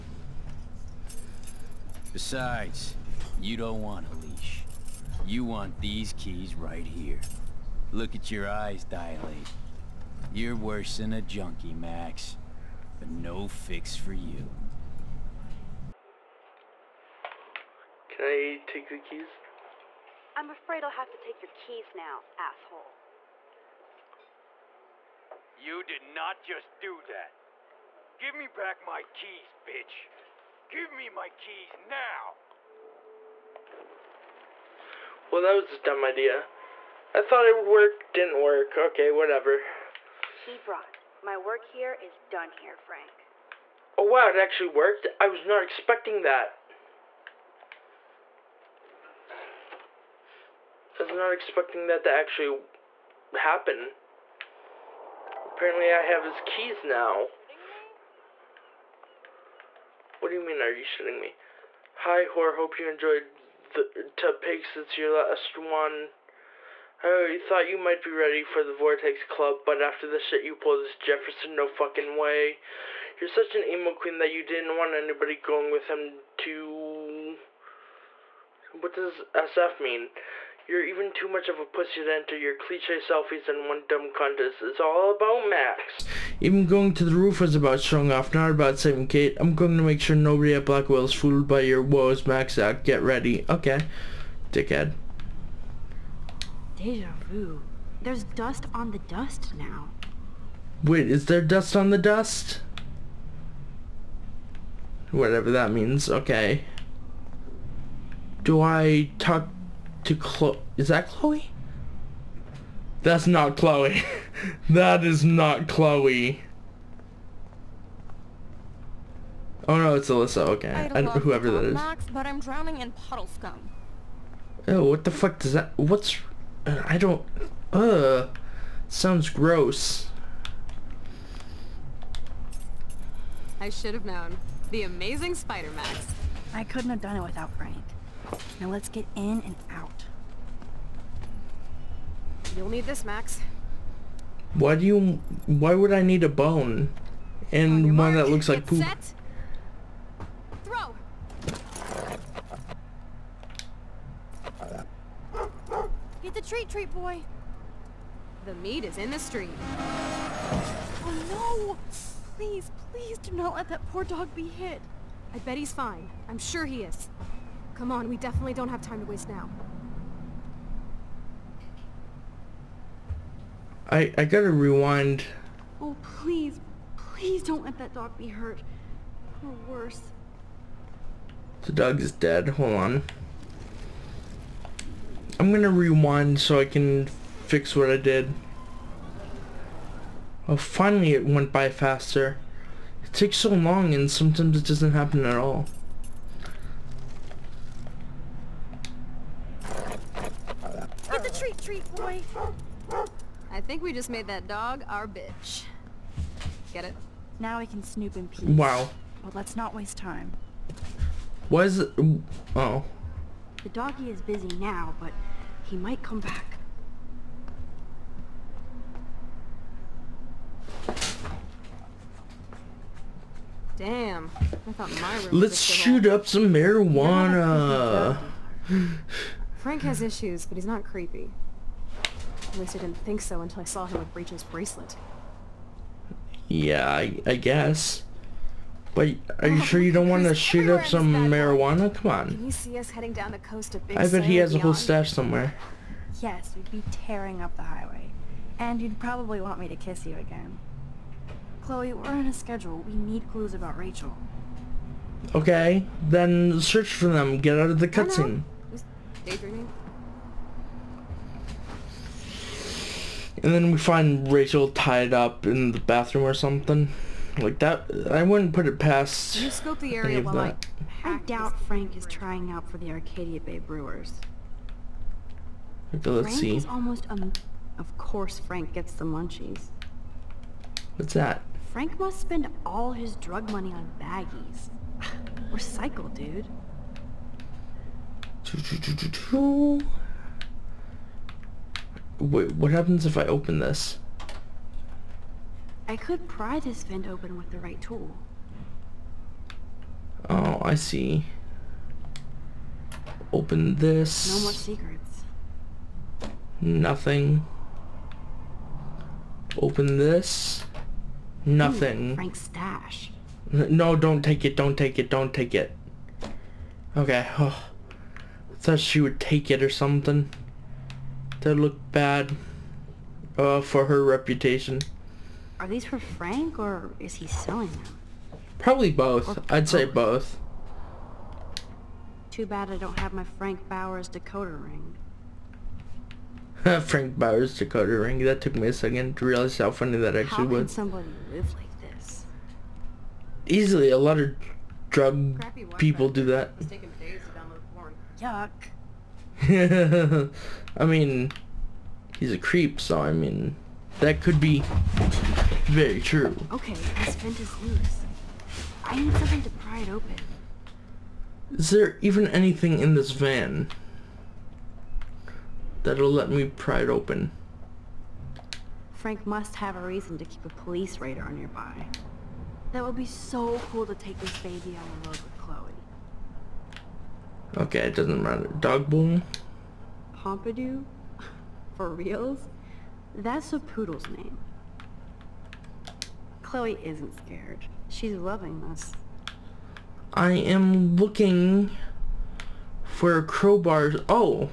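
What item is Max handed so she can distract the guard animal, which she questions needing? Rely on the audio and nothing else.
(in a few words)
A bone.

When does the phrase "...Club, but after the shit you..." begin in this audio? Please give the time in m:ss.
1:09.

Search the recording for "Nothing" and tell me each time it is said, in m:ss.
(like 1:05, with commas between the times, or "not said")
5:06, 5:11.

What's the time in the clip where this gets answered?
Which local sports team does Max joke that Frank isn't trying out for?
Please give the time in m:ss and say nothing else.
4:32.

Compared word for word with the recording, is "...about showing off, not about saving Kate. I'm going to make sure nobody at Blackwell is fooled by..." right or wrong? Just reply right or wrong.
right.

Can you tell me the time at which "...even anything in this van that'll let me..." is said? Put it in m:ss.
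6:02.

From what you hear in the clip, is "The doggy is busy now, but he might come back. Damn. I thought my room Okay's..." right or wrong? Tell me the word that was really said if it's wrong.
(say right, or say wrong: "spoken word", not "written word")
wrong: "Let", not "Okay".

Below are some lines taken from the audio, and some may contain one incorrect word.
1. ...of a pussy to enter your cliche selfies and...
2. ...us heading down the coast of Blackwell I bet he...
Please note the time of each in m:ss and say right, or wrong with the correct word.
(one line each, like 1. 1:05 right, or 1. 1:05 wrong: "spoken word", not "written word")
1. 1:21 right
2. 4:02 wrong: "Big", not "Blackwell".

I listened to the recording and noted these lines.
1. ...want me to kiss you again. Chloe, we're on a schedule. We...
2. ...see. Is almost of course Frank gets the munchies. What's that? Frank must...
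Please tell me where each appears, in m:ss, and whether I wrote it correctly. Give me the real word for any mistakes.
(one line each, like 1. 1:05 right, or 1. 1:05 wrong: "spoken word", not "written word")
1. 4:09 right
2. 4:36 right.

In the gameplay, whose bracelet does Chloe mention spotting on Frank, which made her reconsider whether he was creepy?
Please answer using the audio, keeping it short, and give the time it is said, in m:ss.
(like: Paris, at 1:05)
Breach, at 3:54.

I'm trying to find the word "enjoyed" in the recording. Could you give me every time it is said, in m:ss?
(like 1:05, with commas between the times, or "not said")
1:02.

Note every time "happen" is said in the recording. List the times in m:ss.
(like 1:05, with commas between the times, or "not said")
0:53, 3:14, 4:52.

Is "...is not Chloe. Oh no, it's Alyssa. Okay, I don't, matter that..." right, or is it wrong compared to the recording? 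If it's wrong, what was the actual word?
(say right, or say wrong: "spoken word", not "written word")
wrong: "whoever", not "matter".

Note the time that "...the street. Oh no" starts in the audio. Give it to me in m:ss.
2:39.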